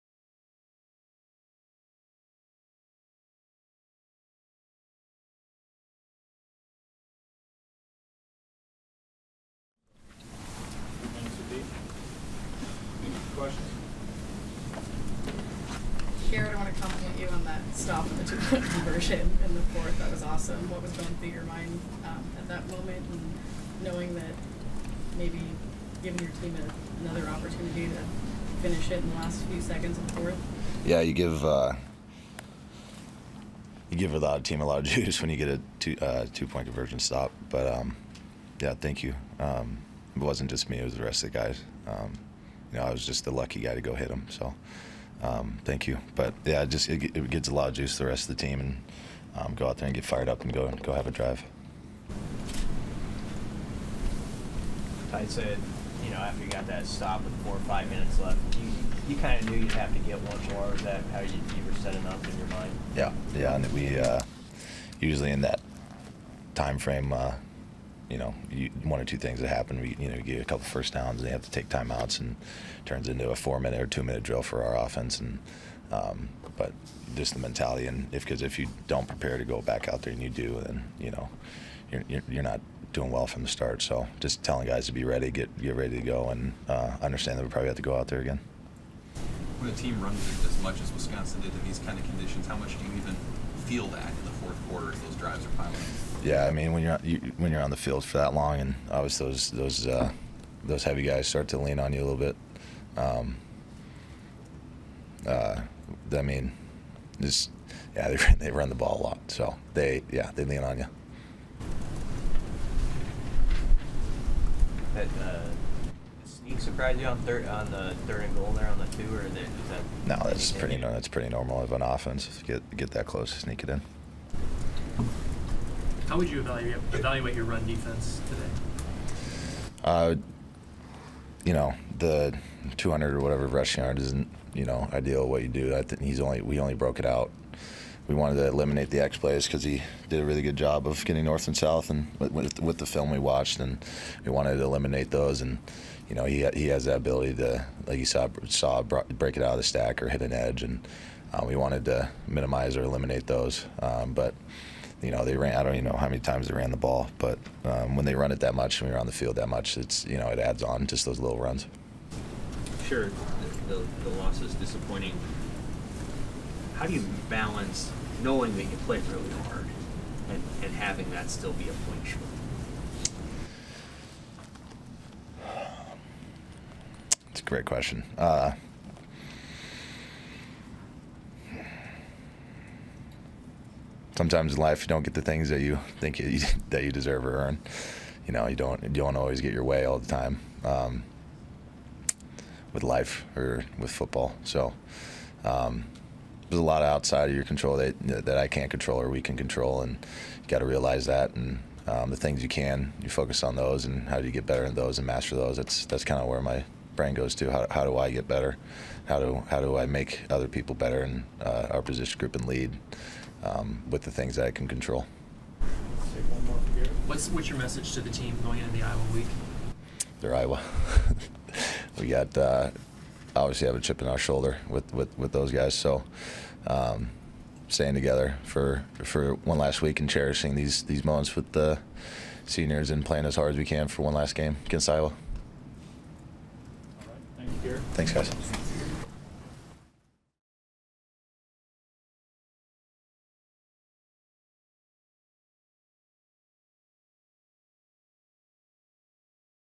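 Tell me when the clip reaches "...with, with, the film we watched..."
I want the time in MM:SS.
02:22.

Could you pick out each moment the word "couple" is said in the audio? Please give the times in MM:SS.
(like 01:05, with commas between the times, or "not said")
01:10.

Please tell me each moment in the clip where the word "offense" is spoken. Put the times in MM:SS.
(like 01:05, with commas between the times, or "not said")
01:14, 02:01.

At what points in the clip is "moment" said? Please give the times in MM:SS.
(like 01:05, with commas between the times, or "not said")
00:22, 03:51.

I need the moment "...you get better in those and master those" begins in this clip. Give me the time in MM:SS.
03:24.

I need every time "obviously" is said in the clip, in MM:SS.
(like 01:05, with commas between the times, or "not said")
01:38, 03:43.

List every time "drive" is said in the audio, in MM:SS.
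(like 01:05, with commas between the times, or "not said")
00:51, 01:35.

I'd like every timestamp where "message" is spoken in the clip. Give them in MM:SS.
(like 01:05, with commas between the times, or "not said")
03:37.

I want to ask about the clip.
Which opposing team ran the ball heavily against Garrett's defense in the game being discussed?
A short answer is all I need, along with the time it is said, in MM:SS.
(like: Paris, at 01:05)
Wisconsin, at 01:30.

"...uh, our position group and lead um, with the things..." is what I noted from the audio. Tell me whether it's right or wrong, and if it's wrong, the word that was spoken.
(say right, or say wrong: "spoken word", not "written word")
right.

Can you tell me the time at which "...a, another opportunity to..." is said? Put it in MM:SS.
00:26.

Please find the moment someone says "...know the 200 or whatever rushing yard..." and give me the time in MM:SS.
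02:11.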